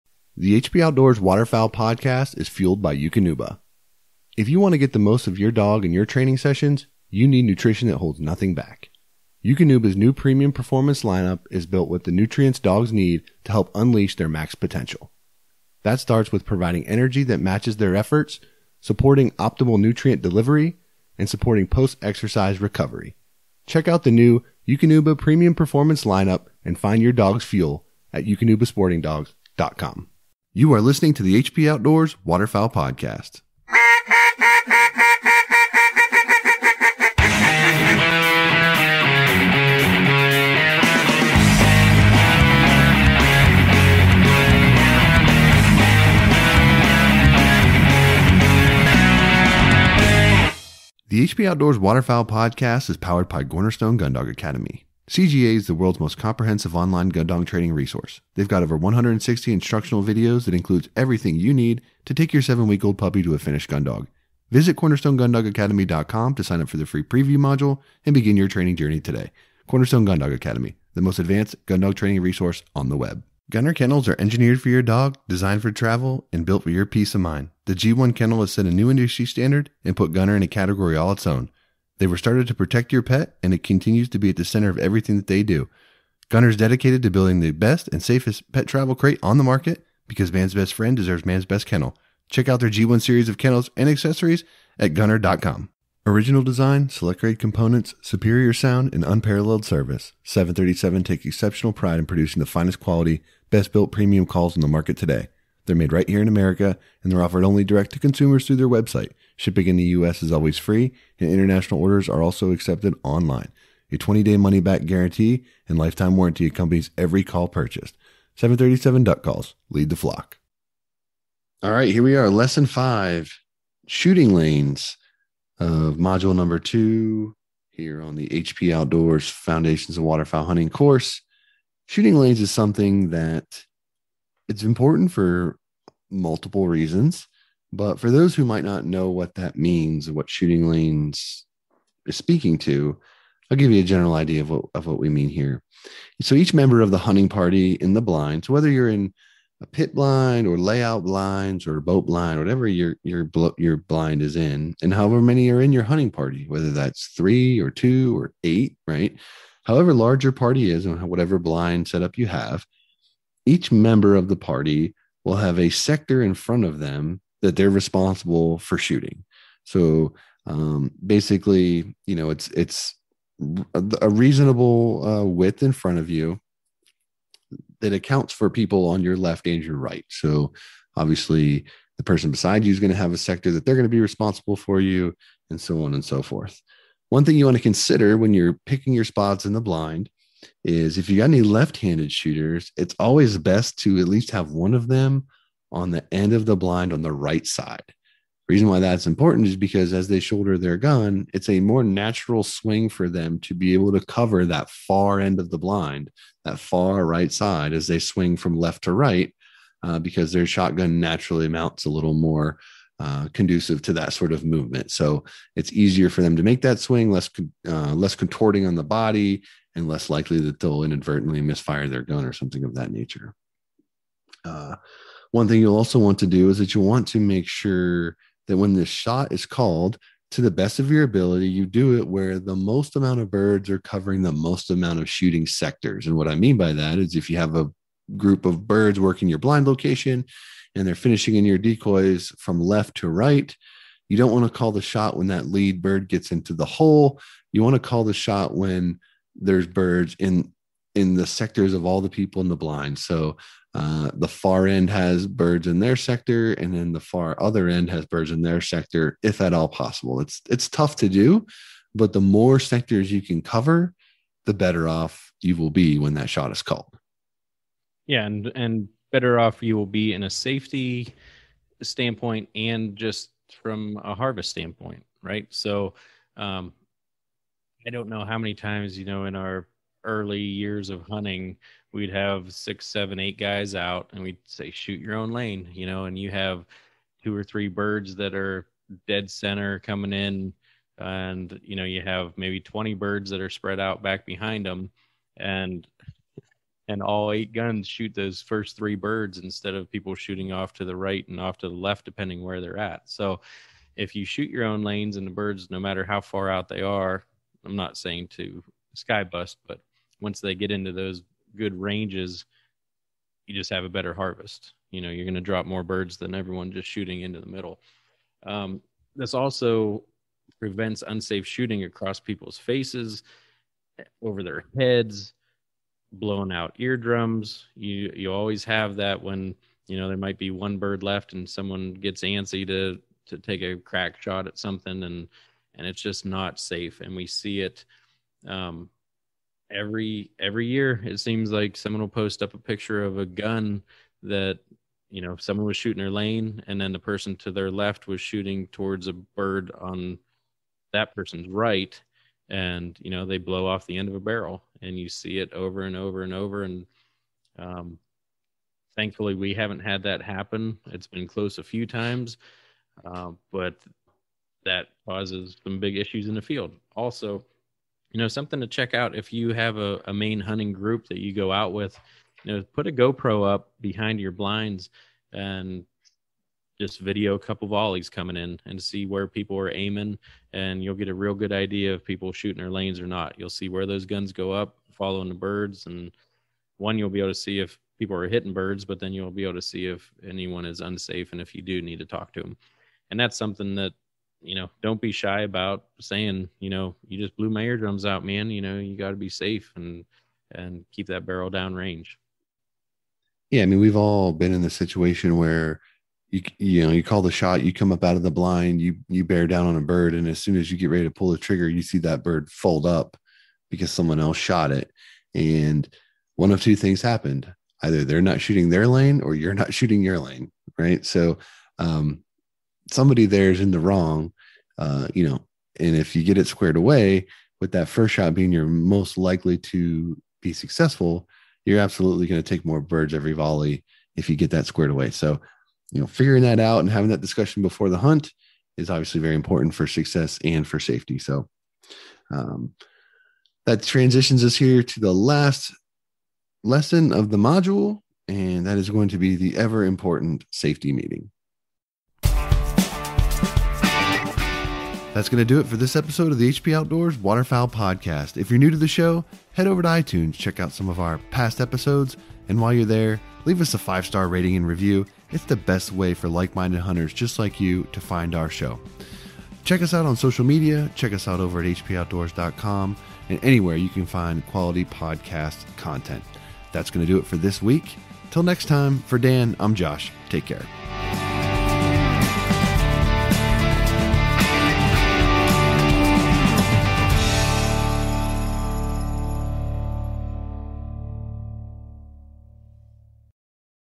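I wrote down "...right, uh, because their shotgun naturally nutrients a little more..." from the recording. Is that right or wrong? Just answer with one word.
wrong.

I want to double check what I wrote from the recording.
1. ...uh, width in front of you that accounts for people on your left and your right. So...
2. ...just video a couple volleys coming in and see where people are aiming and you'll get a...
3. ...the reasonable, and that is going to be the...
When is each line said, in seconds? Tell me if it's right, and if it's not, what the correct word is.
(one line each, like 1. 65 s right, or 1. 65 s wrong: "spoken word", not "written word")
1. 175 s right
2. 376 s right
3. 447 s wrong: "module", not "reasonable".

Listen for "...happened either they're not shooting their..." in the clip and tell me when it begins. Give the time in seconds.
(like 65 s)
417 s.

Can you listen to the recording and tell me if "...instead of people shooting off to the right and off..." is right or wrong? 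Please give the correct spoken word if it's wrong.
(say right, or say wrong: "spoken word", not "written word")
right.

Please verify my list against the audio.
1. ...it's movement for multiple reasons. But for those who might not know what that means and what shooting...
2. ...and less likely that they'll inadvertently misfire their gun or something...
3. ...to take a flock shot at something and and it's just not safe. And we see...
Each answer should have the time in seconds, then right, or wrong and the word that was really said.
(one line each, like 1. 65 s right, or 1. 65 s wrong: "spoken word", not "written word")
1. 134 s wrong: "important", not "movement"
2. 219 s right
3. 333 s wrong: "crack", not "flock".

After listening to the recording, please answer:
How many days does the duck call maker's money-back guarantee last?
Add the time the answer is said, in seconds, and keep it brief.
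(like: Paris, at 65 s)
20 days, at 113 s.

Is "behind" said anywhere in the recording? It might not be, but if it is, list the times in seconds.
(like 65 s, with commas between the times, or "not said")
294 s, 373 s.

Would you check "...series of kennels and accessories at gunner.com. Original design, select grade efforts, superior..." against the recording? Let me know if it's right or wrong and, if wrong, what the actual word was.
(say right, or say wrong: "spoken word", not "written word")
wrong: "components", not "efforts".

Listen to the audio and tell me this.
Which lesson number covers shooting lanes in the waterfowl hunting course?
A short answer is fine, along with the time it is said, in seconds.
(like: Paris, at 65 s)
Lesson 5, at 122 s.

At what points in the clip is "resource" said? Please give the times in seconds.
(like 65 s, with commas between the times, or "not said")
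57 s, 72 s.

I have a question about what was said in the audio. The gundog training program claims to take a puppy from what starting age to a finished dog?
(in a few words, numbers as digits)
7 weeks old.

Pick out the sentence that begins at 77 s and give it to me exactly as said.
The G1 kennel has set a new industry standard and put Gunner in a category all its own.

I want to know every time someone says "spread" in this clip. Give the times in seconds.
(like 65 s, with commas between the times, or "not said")
293 s.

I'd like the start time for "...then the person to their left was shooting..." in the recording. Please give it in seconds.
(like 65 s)
346 s.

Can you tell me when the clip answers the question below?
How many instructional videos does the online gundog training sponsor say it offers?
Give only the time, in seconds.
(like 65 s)
58 s.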